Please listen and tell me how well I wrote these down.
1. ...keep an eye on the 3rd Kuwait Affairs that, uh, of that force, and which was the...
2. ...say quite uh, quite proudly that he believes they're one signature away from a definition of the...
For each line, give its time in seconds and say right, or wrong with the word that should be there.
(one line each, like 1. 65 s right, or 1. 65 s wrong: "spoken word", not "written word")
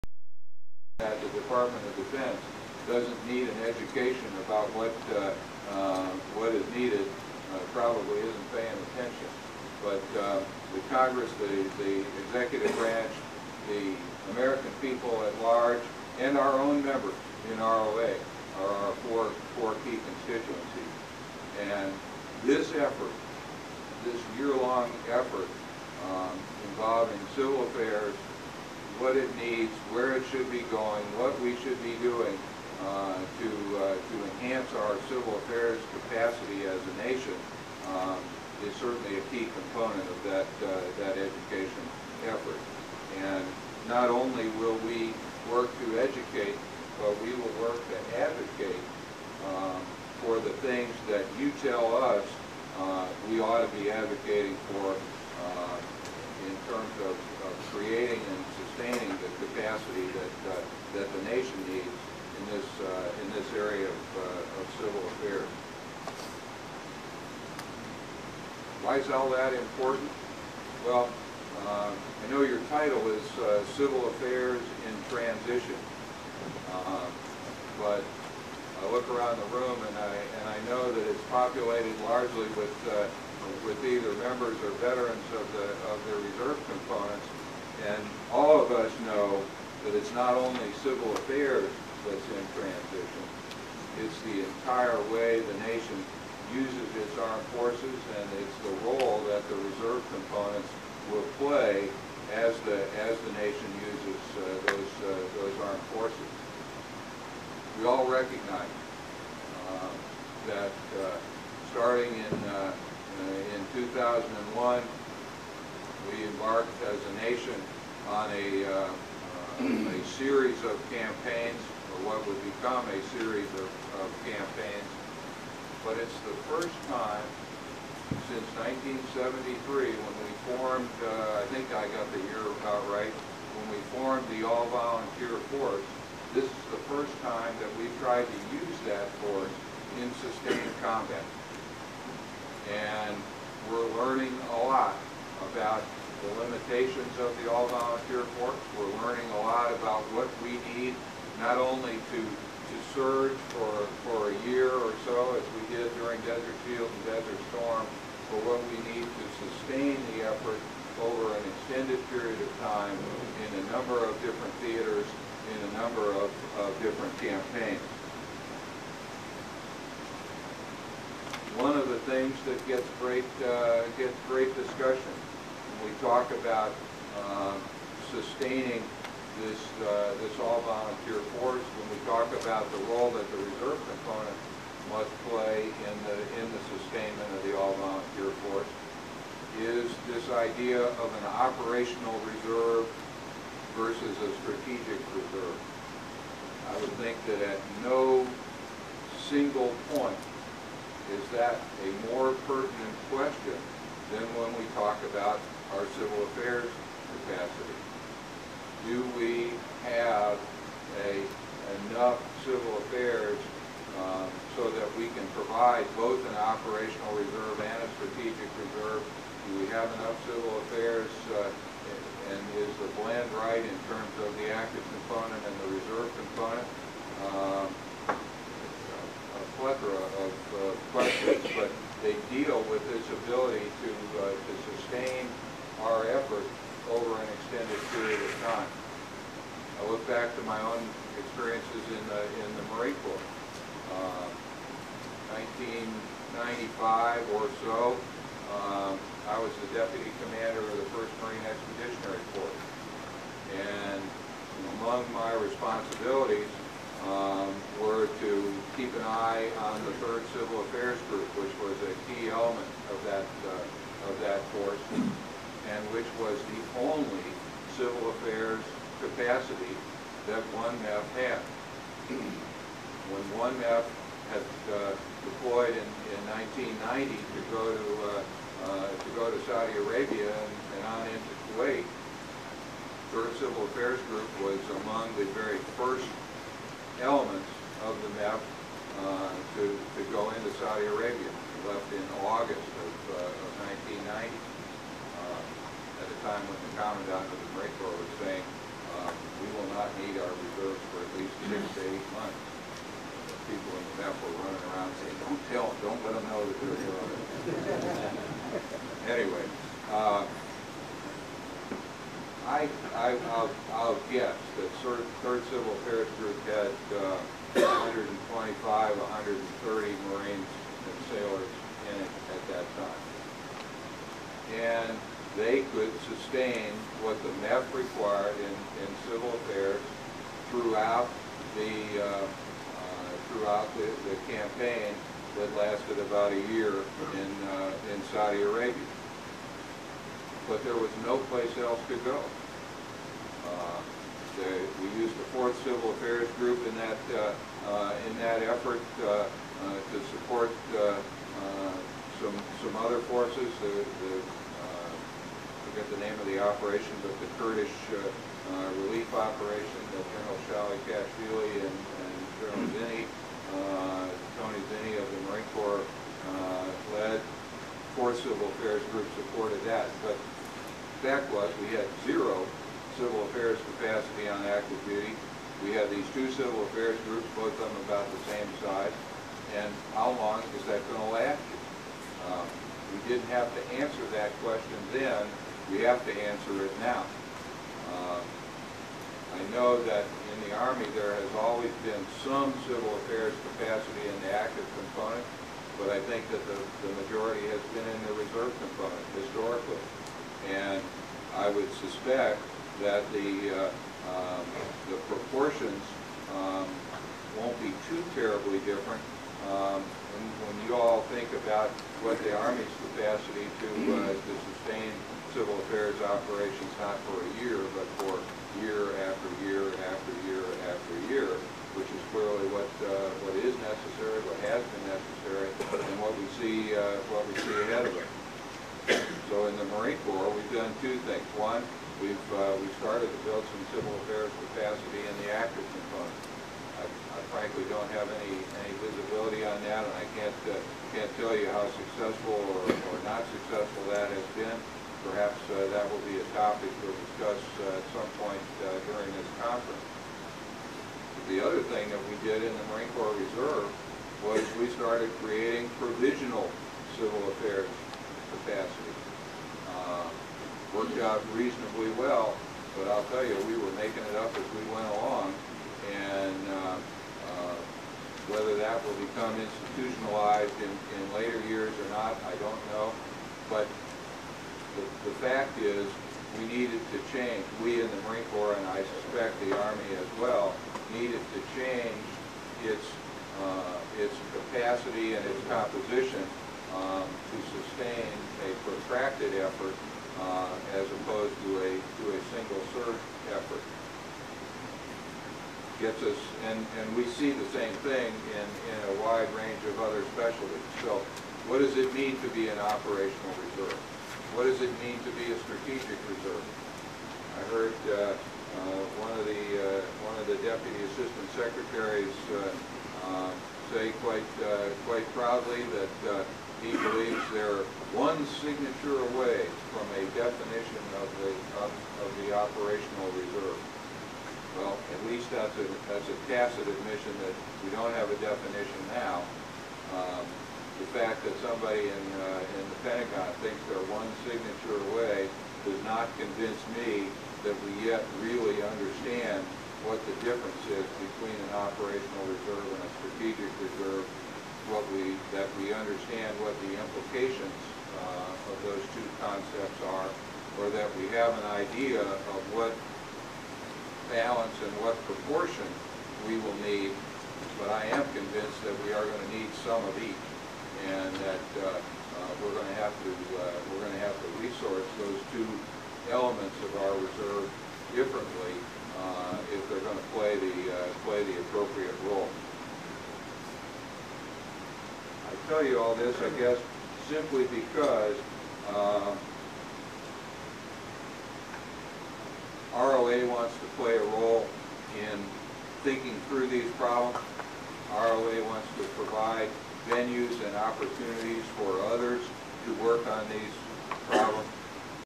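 1. 258 s wrong: "Civil", not "Kuwait"
2. 513 s right.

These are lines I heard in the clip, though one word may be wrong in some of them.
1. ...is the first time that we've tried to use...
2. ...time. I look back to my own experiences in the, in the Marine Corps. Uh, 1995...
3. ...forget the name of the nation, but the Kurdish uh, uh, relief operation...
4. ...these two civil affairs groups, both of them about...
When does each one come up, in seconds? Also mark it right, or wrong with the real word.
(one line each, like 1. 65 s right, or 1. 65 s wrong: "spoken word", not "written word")
1. 136 s right
2. 238 s right
3. 355 s wrong: "operation", not "nation"
4. 375 s right.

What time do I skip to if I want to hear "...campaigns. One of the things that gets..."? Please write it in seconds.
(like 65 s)
167 s.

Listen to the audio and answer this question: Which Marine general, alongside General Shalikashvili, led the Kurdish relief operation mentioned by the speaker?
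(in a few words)
Tony Zinni.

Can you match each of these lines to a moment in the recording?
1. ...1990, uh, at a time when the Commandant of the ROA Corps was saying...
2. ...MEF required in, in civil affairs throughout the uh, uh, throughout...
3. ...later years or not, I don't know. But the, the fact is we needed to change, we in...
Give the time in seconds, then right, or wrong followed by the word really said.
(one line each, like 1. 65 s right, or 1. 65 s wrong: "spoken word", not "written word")
1. 293 s wrong: "Marine", not "ROA"
2. 327 s right
3. 471 s right.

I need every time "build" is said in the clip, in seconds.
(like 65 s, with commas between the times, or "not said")
433 s.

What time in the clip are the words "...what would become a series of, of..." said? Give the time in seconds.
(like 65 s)
122 s.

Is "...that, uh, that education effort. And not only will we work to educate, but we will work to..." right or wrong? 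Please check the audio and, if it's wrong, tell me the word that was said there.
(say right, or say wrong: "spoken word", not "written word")
right.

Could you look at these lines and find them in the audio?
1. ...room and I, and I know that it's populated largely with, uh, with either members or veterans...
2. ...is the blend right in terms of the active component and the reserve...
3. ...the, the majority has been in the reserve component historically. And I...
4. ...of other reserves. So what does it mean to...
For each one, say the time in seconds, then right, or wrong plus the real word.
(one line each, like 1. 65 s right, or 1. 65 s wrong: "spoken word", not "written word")
1. 79 s right
2. 222 s right
3. 396 s right
4. 499 s wrong: "specialties", not "reserves".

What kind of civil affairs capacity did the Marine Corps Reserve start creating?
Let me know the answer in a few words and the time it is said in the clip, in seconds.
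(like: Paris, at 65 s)
Provisional, at 455 s.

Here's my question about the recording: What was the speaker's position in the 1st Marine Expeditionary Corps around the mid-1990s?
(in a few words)
Deputy commander.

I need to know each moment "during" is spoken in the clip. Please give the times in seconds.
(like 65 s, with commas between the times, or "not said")
155 s, 448 s.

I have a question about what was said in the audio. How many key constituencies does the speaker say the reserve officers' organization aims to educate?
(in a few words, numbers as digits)
4.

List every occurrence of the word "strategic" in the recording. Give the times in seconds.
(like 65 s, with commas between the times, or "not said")
194 s, 218 s, 505 s, 542 s.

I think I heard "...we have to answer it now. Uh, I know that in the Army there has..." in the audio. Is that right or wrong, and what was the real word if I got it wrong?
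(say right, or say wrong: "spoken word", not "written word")
right.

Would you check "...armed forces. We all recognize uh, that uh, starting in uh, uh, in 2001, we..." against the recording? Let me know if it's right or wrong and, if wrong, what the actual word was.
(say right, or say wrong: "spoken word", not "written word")
right.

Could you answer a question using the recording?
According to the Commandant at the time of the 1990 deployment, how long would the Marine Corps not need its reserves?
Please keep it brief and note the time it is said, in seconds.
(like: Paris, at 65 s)
6 to 8 months, at 301 s.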